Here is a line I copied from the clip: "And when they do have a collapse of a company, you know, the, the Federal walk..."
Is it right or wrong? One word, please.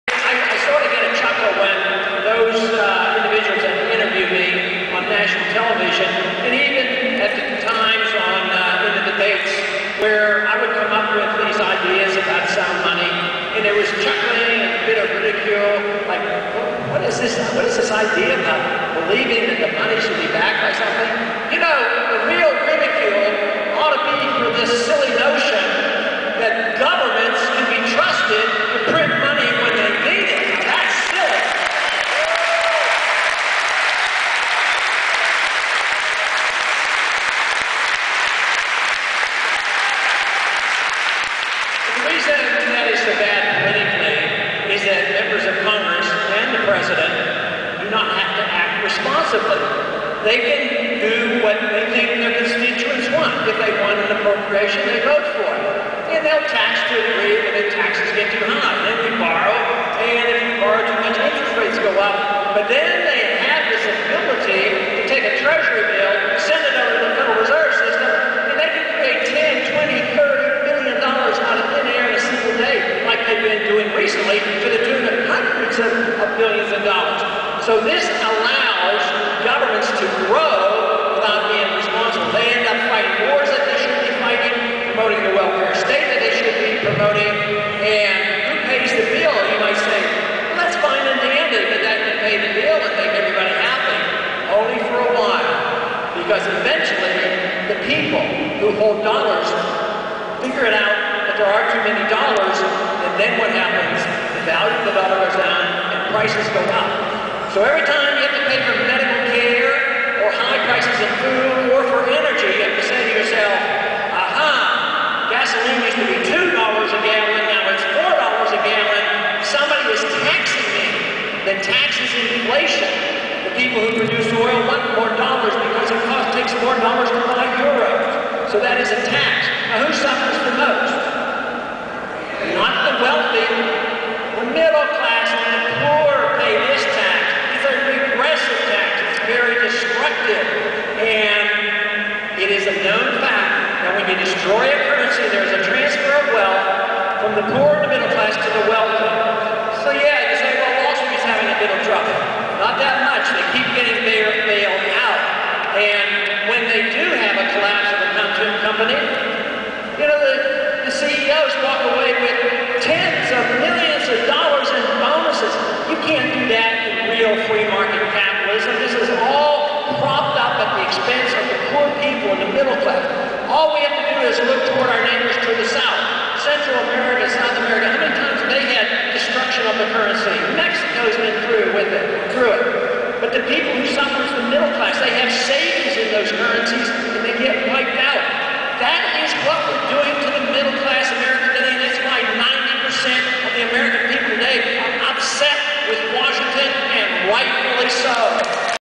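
wrong.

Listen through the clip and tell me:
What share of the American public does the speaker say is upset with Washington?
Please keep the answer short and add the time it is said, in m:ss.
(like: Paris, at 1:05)
90%, at 3:12.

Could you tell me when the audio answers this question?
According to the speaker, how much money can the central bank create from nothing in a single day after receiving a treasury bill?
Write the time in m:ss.
1:09.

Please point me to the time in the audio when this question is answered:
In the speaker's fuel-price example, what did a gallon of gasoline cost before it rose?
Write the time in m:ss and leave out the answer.
1:56.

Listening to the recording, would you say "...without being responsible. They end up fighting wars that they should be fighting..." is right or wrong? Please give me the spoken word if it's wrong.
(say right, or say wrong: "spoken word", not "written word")
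right.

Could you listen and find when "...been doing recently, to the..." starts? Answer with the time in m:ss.
1:13.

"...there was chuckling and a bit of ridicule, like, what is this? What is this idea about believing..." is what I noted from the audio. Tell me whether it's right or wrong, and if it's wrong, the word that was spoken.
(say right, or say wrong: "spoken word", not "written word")
right.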